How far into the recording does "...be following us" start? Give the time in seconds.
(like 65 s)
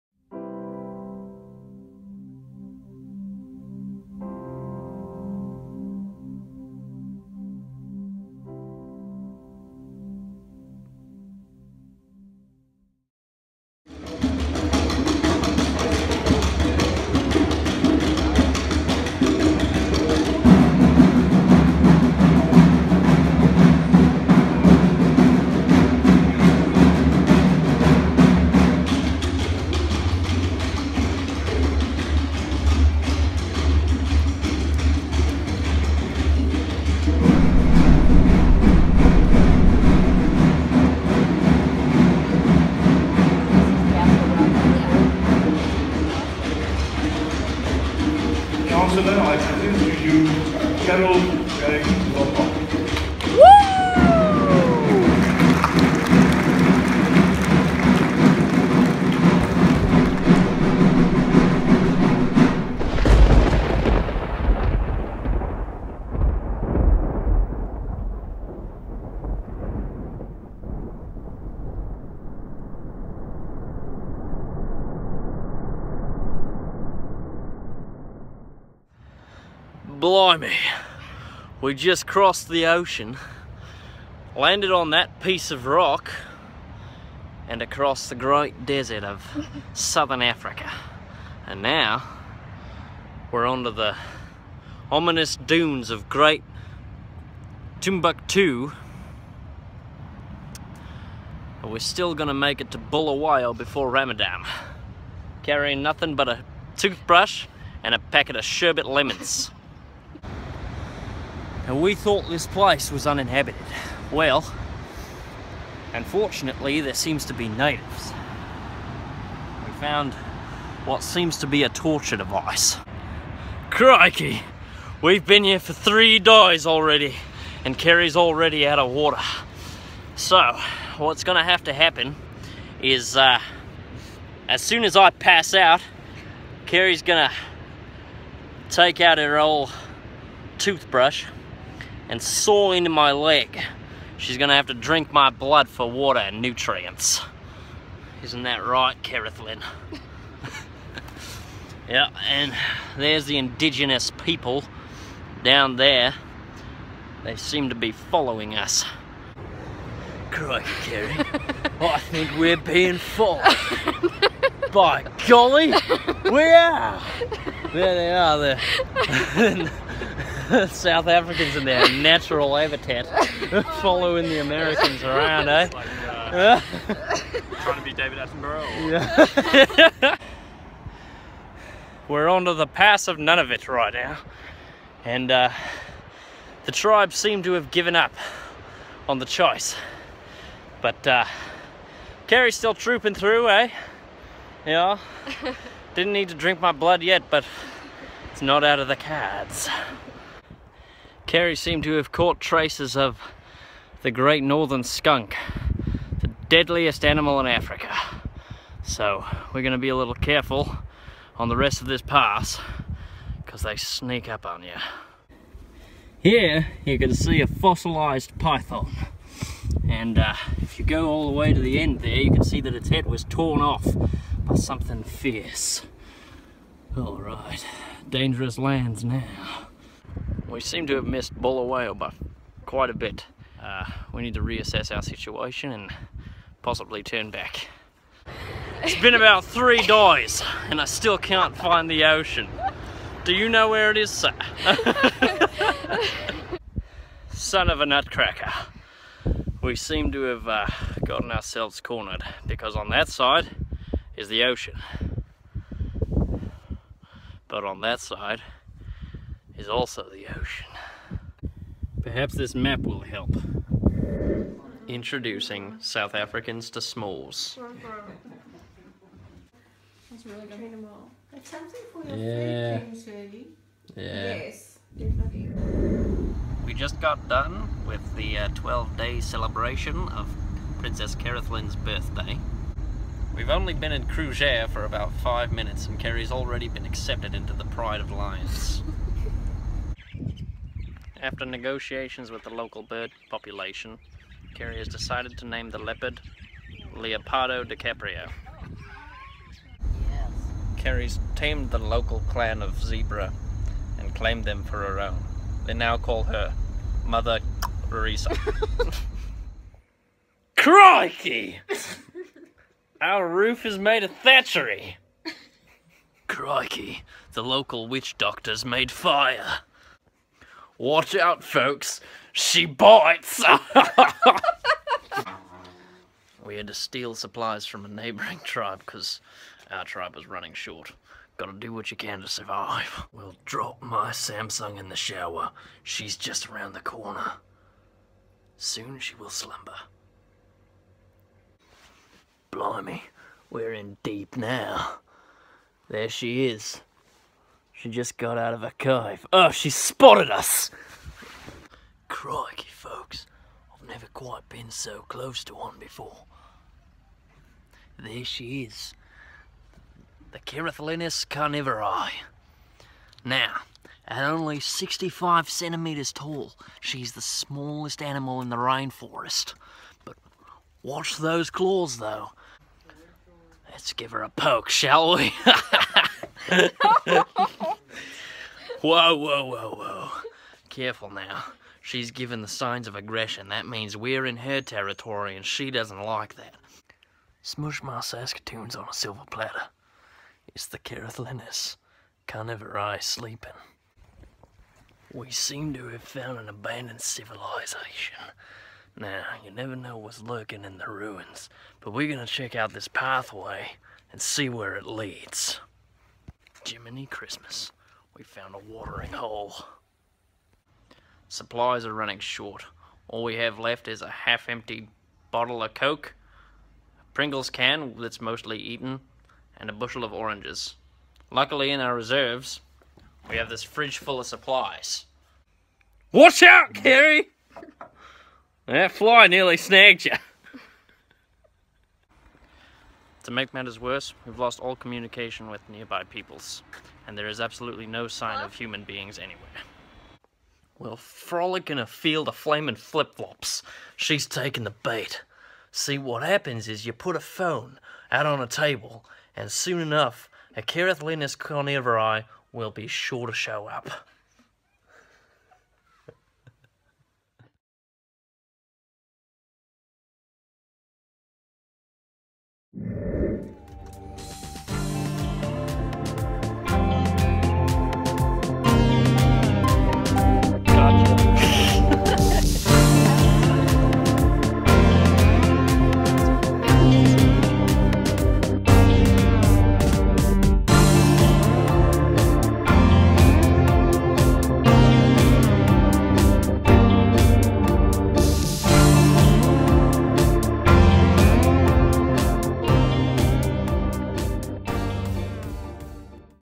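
157 s.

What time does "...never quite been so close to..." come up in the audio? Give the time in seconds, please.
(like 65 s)
353 s.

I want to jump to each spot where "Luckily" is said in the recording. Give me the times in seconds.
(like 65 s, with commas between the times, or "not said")
421 s.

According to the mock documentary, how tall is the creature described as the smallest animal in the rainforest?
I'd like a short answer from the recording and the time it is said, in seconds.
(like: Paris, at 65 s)
65 centimeters, at 364 s.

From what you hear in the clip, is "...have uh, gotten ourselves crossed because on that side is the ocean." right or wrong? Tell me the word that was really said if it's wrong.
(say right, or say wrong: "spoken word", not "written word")
wrong: "cornered", not "crossed".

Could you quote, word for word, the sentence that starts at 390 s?
It's the Careth Linus, carnivore sleeping.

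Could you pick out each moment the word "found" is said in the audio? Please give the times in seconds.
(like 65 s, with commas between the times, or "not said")
119 s, 396 s, 408 s.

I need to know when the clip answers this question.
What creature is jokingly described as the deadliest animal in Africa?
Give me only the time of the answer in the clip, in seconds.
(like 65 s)
204 s.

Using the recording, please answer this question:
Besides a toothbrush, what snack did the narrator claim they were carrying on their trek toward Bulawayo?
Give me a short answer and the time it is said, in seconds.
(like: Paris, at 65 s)
sherbet lemons, at 108 s.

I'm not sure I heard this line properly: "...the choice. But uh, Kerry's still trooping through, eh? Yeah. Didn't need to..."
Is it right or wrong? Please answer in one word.
right.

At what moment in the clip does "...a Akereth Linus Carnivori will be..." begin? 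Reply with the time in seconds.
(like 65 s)
450 s.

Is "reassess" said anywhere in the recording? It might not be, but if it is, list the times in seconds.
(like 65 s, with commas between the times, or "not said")
234 s.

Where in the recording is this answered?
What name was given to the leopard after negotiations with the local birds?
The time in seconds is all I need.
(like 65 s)
296 s.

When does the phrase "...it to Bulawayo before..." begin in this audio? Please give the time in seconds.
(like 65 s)
102 s.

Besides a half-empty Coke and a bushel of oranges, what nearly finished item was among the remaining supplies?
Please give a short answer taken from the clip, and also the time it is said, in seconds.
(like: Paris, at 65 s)
Pringles can, at 417 s.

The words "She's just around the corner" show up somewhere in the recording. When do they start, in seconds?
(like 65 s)
335 s.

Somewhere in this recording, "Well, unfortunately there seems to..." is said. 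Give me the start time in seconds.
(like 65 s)
114 s.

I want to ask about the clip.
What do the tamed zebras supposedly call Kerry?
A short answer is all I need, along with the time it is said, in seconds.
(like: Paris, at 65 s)
Mother Risa, at 307 s.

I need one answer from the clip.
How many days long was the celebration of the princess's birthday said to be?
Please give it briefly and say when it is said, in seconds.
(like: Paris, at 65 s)
12, at 278 s.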